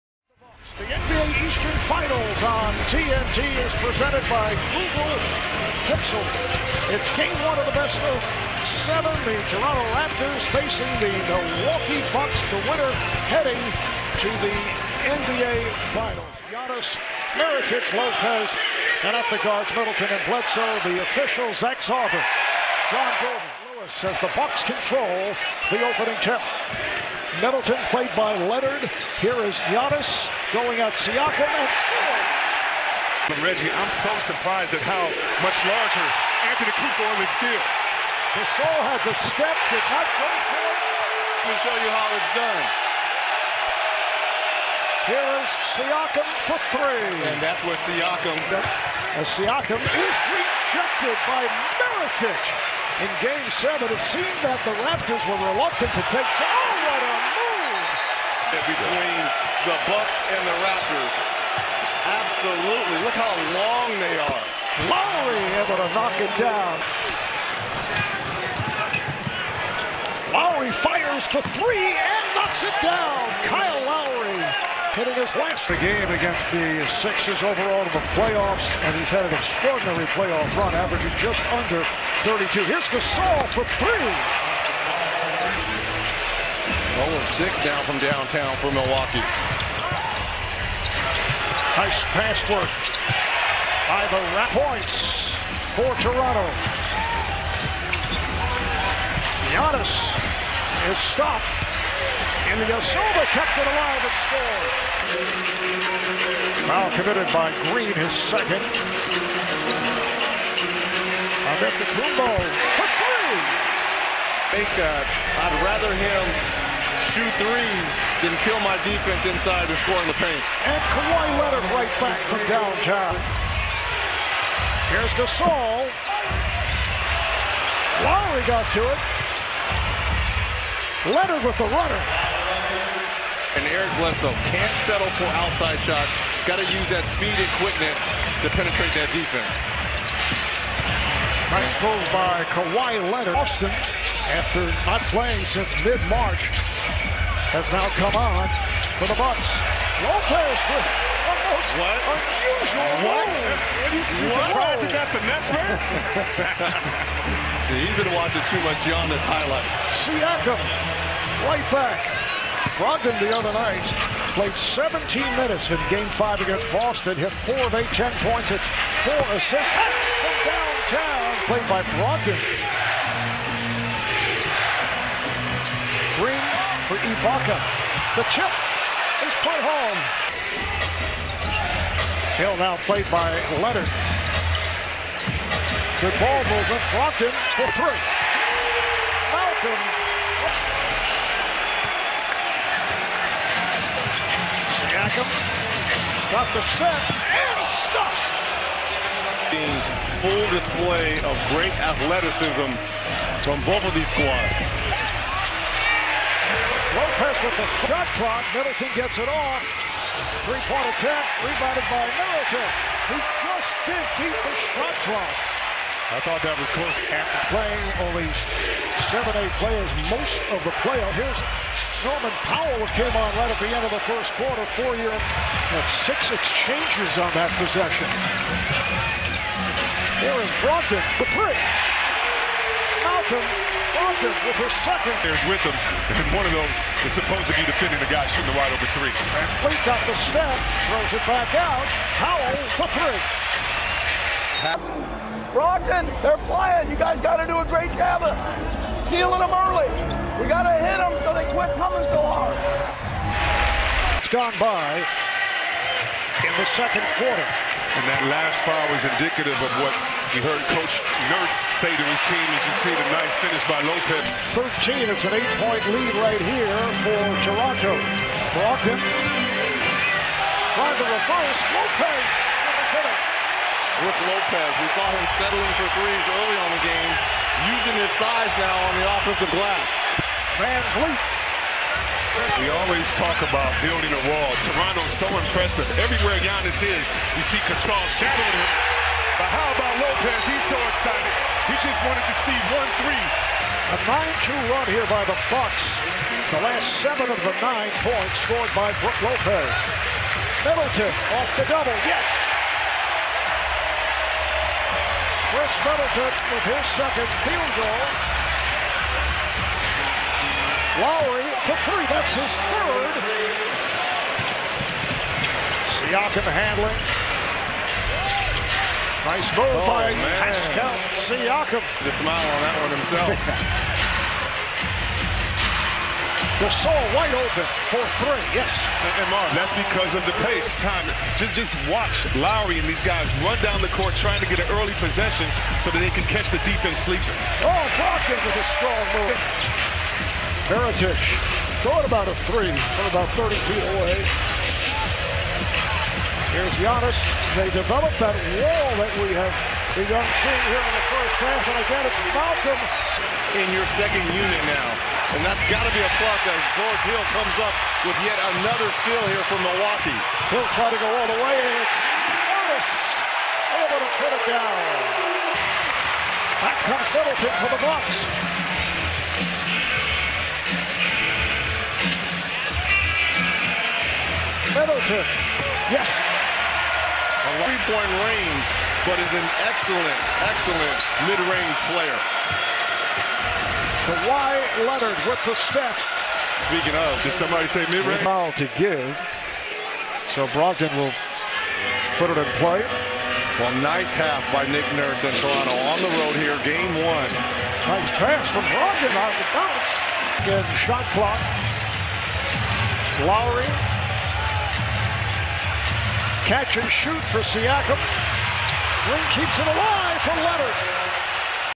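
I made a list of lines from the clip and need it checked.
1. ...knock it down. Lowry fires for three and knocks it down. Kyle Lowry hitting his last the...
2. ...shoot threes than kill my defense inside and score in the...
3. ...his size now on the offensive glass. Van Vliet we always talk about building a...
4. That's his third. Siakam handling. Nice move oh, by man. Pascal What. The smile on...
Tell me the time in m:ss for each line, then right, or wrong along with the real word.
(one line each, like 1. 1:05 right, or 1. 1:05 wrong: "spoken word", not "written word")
1. 1:05 right
2. 1:57 right
3. 4:37 right
4. 5:12 wrong: "Siakam", not "What".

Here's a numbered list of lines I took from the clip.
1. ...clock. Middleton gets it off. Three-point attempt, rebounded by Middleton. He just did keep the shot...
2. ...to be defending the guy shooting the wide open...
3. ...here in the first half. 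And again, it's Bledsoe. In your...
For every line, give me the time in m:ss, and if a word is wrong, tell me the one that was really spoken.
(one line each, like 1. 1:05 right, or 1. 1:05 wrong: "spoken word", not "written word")
1. 3:28 right
2. 3:57 right
3. 5:50 wrong: "Malcolm", not "Bledsoe".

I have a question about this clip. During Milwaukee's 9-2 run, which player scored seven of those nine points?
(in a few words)
Brook Lopez.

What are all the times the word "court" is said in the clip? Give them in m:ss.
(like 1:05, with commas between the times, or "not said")
5:33.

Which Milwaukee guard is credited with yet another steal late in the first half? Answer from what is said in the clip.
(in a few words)
George Hill.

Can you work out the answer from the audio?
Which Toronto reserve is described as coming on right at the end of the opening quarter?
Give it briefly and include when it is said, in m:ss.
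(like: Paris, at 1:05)
Norman Powell, at 3:42.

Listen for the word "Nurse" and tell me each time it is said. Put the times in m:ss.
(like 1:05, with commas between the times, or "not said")
4:21, 6:34.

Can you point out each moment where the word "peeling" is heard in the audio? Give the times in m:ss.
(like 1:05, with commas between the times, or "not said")
not said.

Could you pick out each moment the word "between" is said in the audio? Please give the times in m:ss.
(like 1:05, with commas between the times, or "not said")
0:58.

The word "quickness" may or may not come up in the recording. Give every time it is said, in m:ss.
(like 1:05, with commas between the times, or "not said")
2:17.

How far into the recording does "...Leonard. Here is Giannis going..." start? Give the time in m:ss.
0:28.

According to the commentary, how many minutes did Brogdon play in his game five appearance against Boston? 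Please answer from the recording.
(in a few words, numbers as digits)
17.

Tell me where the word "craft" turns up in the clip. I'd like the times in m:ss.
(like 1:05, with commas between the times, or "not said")
not said.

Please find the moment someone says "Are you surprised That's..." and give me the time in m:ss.
2:33.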